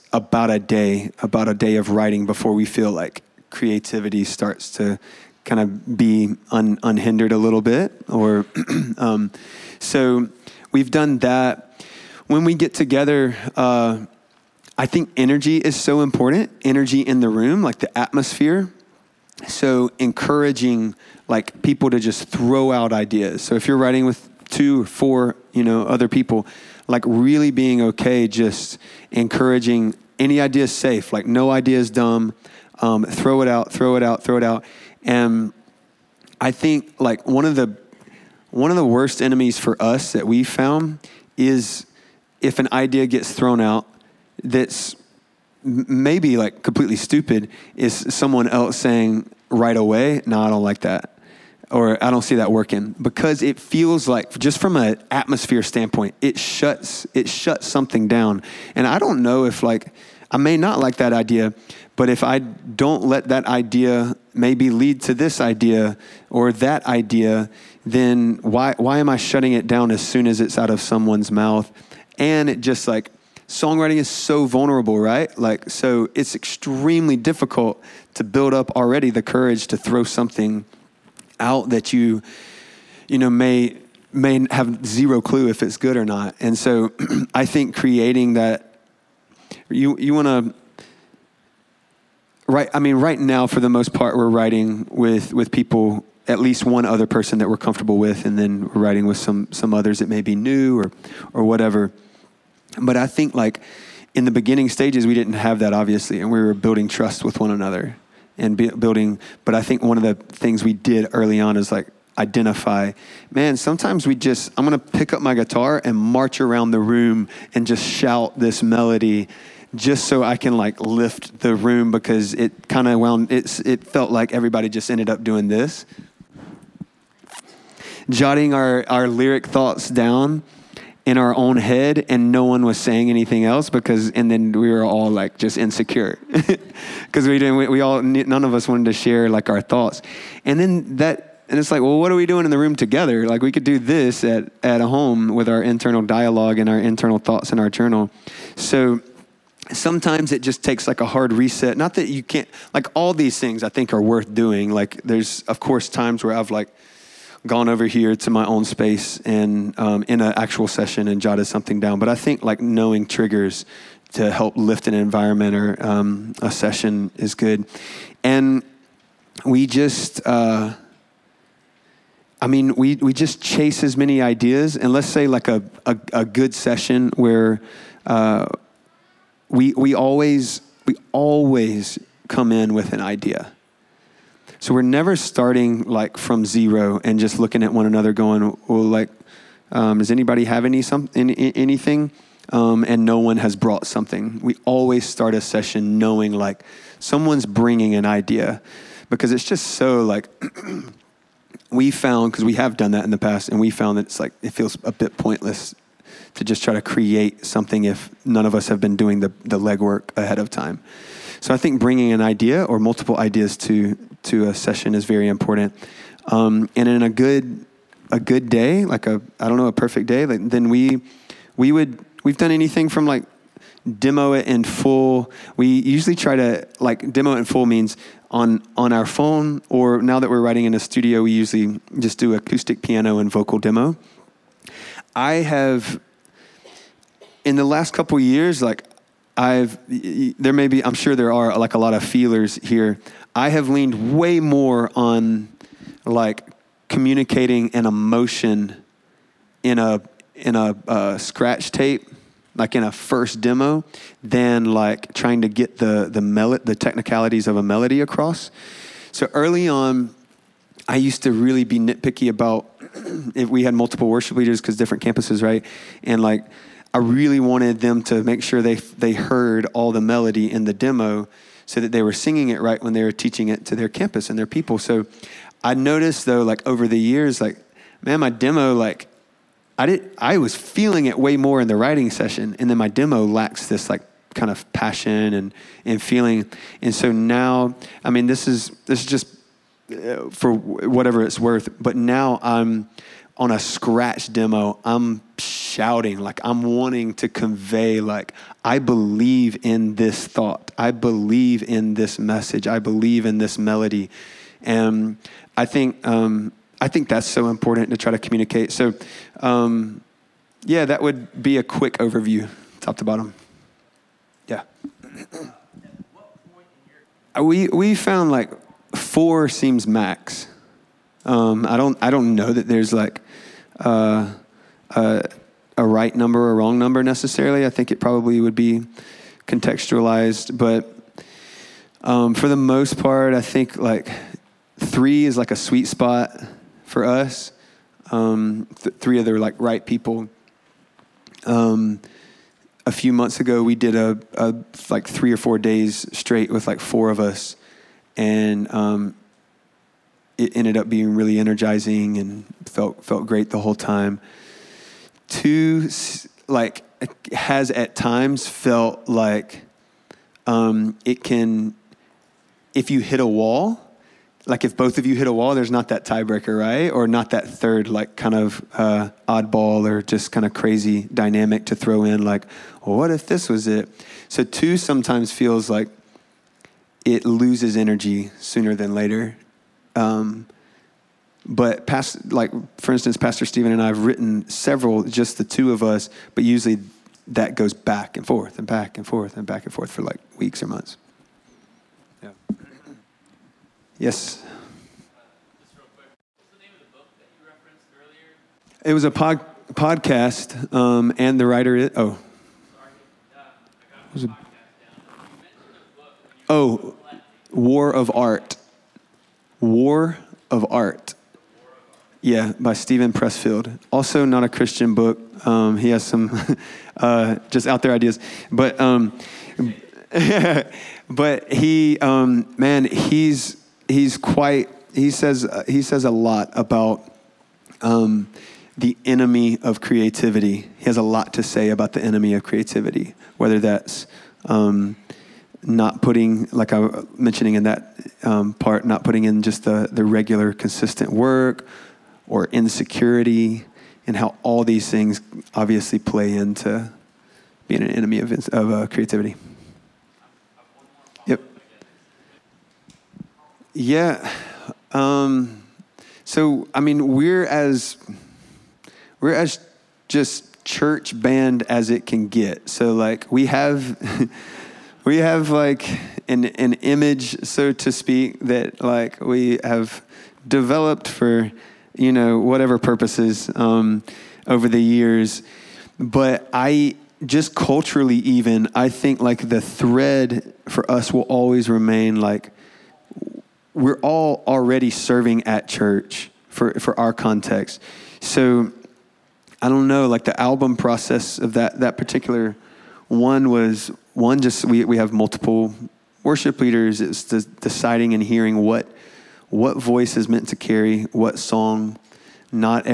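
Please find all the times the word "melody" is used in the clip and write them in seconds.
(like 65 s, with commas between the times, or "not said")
118 s, 257 s, 270 s, 303 s.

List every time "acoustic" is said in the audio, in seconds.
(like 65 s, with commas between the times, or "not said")
232 s.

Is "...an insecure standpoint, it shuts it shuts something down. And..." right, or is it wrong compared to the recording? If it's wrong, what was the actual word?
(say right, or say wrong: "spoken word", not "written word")
wrong: "atmosphere", not "insecure".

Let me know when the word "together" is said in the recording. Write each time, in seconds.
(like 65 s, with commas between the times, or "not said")
12 s, 142 s.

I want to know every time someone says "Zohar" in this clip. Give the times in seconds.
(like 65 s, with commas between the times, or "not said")
not said.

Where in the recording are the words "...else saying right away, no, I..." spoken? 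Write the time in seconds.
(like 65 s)
48 s.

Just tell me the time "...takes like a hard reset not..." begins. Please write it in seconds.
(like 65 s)
150 s.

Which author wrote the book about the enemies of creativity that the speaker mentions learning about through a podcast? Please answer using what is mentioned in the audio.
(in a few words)
Steven Pressfield.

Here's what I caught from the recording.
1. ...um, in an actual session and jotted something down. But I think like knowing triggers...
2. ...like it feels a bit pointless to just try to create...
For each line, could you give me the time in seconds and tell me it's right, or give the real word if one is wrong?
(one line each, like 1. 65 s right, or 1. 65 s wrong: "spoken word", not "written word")
1. 159 s right
2. 204 s right.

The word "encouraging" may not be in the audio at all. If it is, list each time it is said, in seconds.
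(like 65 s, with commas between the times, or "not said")
19 s, 29 s.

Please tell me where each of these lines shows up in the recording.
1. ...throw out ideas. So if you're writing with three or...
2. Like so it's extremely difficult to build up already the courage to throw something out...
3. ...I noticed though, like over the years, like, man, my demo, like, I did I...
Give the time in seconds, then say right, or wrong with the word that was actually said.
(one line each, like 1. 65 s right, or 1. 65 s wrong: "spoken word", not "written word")
1. 22 s wrong: "two", not "three"
2. 75 s right
3. 275 s right.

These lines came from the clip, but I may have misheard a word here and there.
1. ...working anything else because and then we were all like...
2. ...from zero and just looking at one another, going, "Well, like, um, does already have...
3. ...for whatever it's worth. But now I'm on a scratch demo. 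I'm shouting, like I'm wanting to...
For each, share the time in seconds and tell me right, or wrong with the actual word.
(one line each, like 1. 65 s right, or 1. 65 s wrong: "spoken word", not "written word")
1. 132 s wrong: "saying", not "working"
2. 186 s wrong: "anybody", not "already"
3. 290 s right.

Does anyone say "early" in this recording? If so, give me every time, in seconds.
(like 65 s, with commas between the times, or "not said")
111 s, 259 s.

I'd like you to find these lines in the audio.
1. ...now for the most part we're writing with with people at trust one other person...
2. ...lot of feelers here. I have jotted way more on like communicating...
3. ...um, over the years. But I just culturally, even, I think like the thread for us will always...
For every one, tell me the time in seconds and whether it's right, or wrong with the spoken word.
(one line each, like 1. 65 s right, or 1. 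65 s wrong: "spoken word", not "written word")
1. 93 s wrong: "least", not "trust"
2. 241 s wrong: "leaned", not "jotted"
3. 473 s right.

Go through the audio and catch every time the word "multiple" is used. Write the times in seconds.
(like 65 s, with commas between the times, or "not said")
212 s, 263 s, 495 s.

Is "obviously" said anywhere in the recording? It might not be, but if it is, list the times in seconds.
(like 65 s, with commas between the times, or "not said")
105 s, 445 s.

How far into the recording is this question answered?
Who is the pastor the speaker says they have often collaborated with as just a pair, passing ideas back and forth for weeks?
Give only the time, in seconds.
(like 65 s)
383 s.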